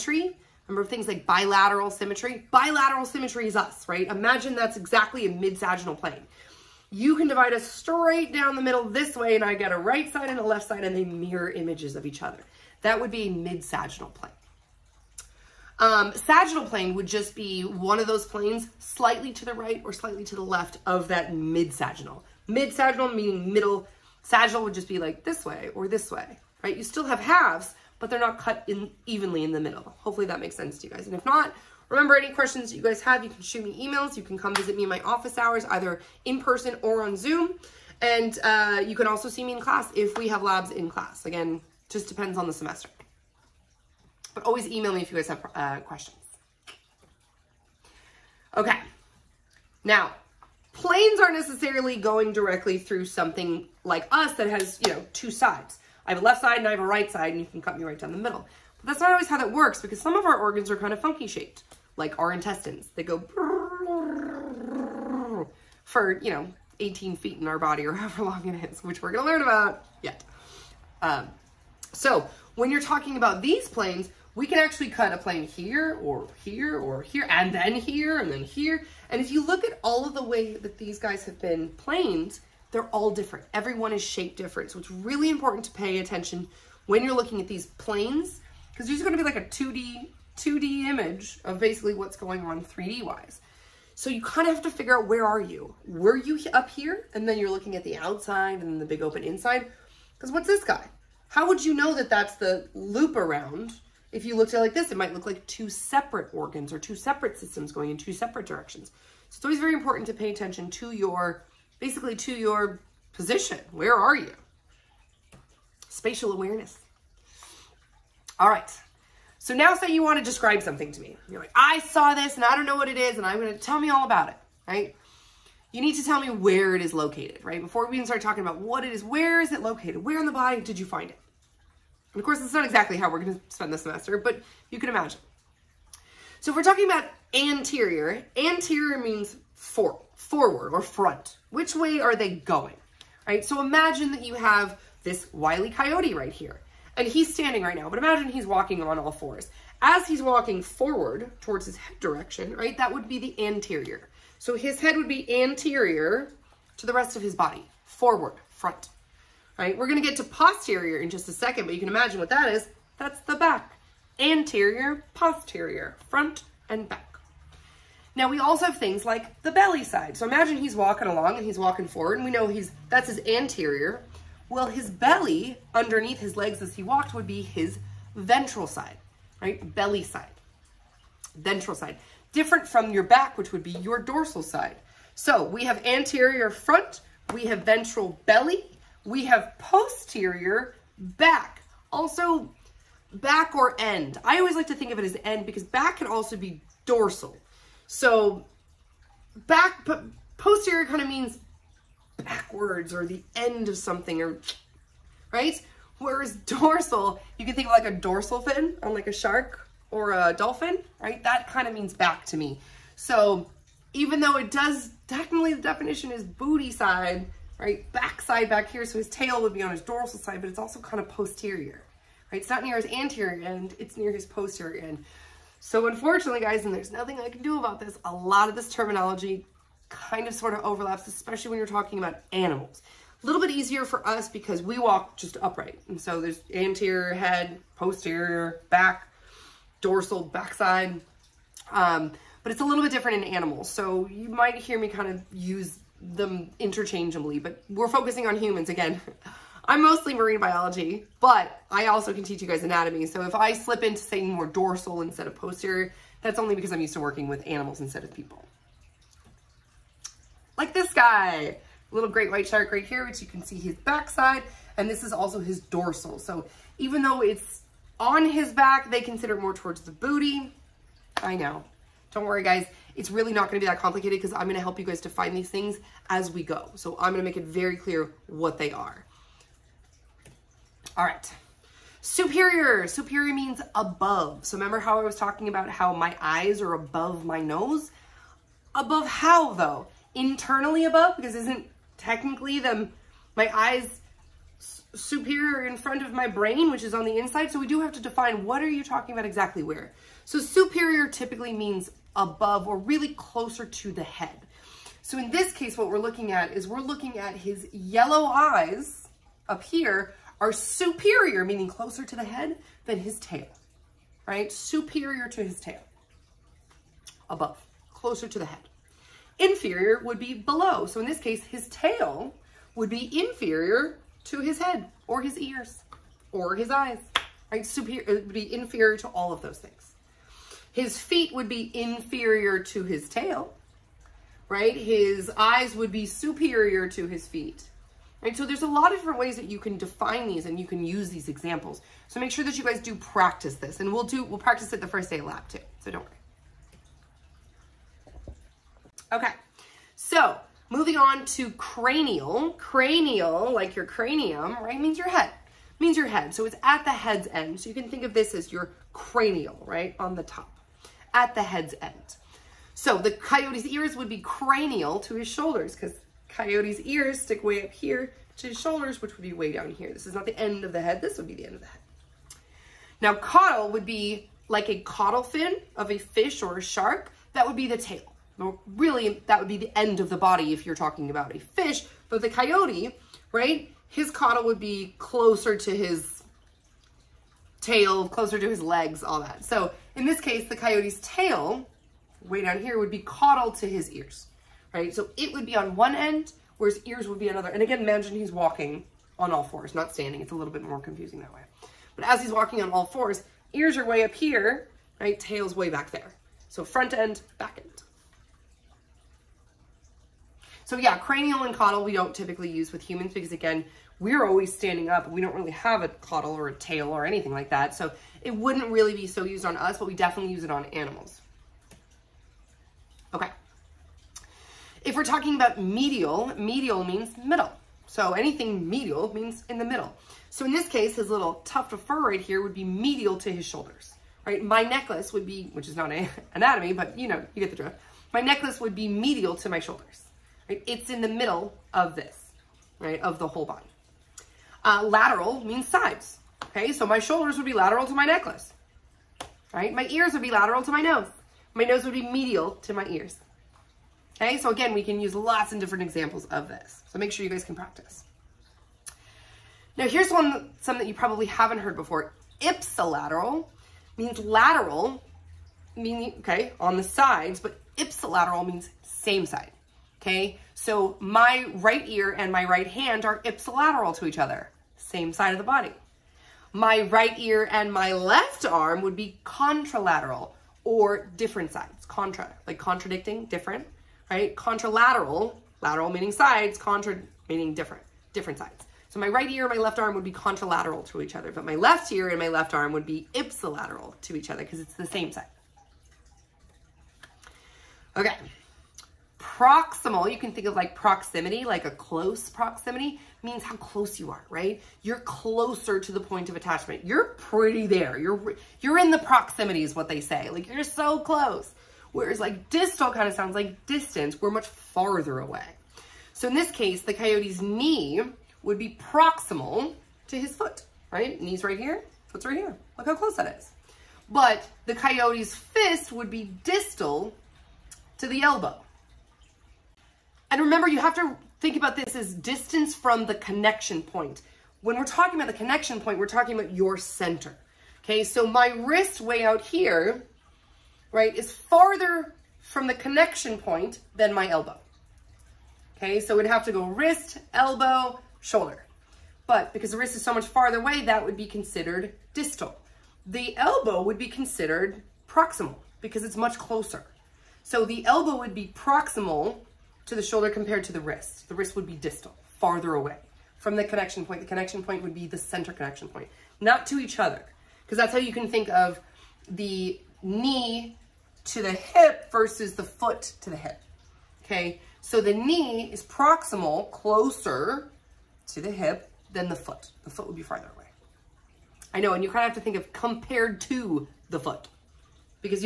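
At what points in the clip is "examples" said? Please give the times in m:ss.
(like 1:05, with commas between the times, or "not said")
5:41, 7:35.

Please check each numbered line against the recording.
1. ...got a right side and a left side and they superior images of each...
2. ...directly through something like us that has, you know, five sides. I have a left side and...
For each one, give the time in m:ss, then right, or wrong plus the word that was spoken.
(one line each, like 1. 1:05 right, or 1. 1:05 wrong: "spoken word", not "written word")
1. 0:09 wrong: "mirror", not "superior"
2. 0:52 wrong: "two", not "five".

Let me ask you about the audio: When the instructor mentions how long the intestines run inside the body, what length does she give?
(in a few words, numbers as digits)
18 feet.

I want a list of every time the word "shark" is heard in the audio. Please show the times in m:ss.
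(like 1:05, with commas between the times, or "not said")
3:29, 4:22, 6:16.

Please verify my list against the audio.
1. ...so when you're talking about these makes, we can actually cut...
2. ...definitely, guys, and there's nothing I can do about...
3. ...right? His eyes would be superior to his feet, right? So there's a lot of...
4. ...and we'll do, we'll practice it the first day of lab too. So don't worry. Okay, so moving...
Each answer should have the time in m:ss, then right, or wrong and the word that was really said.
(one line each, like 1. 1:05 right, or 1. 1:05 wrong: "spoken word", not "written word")
1. 1:11 wrong: "planes", not "makes"
2. 3:45 wrong: "unfortunately", not "definitely"
3. 5:34 right
4. 5:43 right.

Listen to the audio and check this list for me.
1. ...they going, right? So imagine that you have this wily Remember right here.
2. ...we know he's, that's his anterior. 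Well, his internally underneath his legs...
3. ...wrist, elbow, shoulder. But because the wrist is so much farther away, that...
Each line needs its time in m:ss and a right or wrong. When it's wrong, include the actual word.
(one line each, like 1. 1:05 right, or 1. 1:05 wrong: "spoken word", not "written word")
1. 2:22 wrong: "Coyote", not "Remember"
2. 2:52 wrong: "belly", not "internally"
3. 9:06 right.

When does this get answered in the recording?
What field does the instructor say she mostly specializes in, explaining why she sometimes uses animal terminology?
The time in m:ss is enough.
4:10.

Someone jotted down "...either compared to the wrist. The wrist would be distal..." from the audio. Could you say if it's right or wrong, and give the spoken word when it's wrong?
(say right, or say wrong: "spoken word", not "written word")
wrong: "shoulder", not "either".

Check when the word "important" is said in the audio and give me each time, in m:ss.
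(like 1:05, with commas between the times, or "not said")
1:25, 1:49.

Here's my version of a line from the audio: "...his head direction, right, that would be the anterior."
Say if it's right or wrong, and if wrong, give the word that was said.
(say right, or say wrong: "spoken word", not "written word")
right.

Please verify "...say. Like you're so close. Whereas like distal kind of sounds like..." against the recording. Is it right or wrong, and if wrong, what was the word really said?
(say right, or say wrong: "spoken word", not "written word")
right.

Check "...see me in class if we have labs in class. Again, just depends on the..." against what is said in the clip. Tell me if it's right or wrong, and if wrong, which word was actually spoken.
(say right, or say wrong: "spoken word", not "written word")
right.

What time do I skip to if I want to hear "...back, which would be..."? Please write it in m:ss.
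3:03.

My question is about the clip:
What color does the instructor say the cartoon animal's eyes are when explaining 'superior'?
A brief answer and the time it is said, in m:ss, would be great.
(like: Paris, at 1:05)
yellow, at 5:07.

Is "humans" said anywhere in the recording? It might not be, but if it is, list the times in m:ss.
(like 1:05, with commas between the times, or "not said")
4:08, 6:52.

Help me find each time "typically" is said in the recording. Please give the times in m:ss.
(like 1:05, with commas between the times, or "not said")
5:01, 6:52.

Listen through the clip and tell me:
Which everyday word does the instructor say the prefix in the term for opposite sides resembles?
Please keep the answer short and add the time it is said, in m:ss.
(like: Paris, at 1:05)
contradicting, at 8:02.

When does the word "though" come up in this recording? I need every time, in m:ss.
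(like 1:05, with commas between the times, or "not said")
3:34, 4:27, 4:49.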